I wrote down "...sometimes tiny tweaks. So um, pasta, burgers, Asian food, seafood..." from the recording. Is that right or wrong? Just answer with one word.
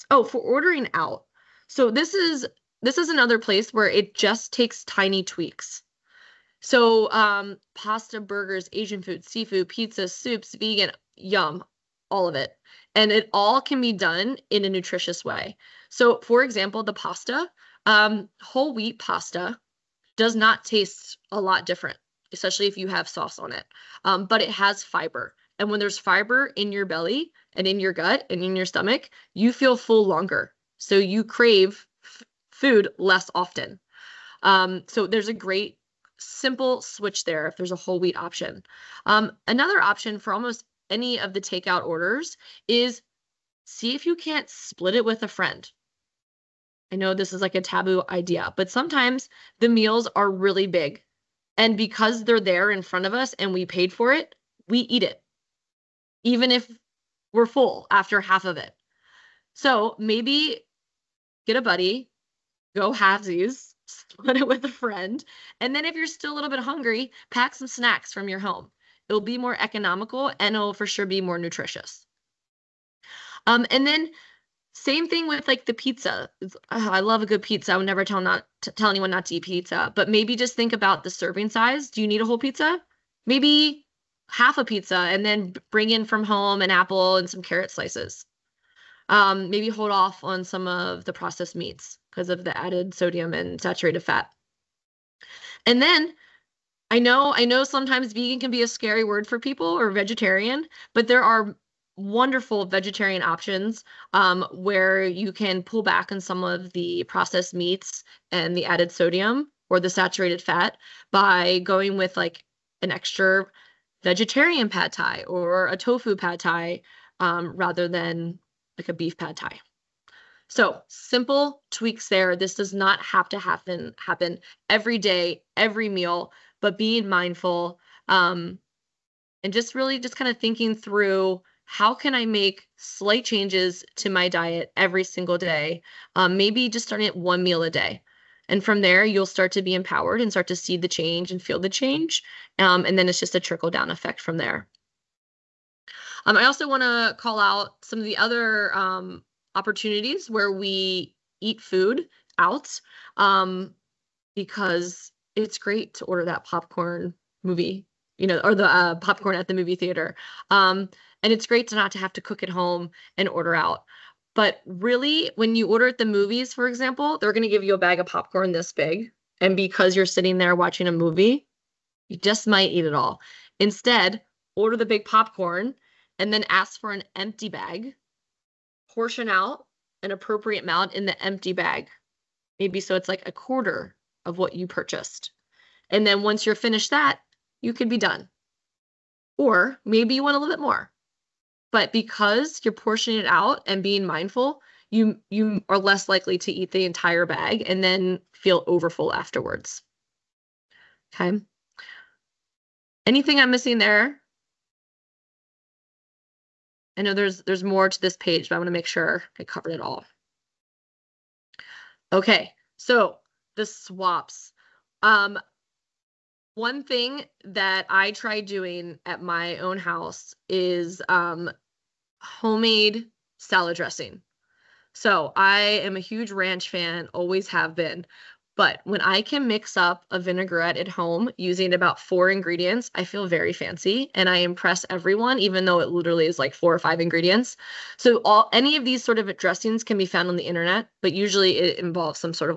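wrong.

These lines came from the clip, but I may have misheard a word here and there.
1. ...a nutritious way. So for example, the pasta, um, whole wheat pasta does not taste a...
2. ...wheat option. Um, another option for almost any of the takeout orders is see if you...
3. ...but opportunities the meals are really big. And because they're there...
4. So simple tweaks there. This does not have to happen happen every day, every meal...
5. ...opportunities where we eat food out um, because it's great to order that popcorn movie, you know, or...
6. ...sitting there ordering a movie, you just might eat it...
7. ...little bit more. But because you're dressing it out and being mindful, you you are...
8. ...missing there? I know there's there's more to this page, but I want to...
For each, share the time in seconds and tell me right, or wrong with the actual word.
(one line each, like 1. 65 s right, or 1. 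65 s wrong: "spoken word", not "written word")
1. 14 s right
2. 37 s right
3. 48 s wrong: "sometimes", not "opportunities"
4. 120 s right
5. 149 s right
6. 170 s wrong: "watching", not "ordering"
7. 190 s wrong: "portioning", not "dressing"
8. 203 s right.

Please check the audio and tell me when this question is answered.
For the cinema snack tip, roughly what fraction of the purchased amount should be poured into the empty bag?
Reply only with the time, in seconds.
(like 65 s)
183 s.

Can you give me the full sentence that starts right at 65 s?
And then if you're still a little bit hungry, pack some snacks from your home.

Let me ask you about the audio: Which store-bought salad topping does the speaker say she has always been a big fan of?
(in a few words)
ranch.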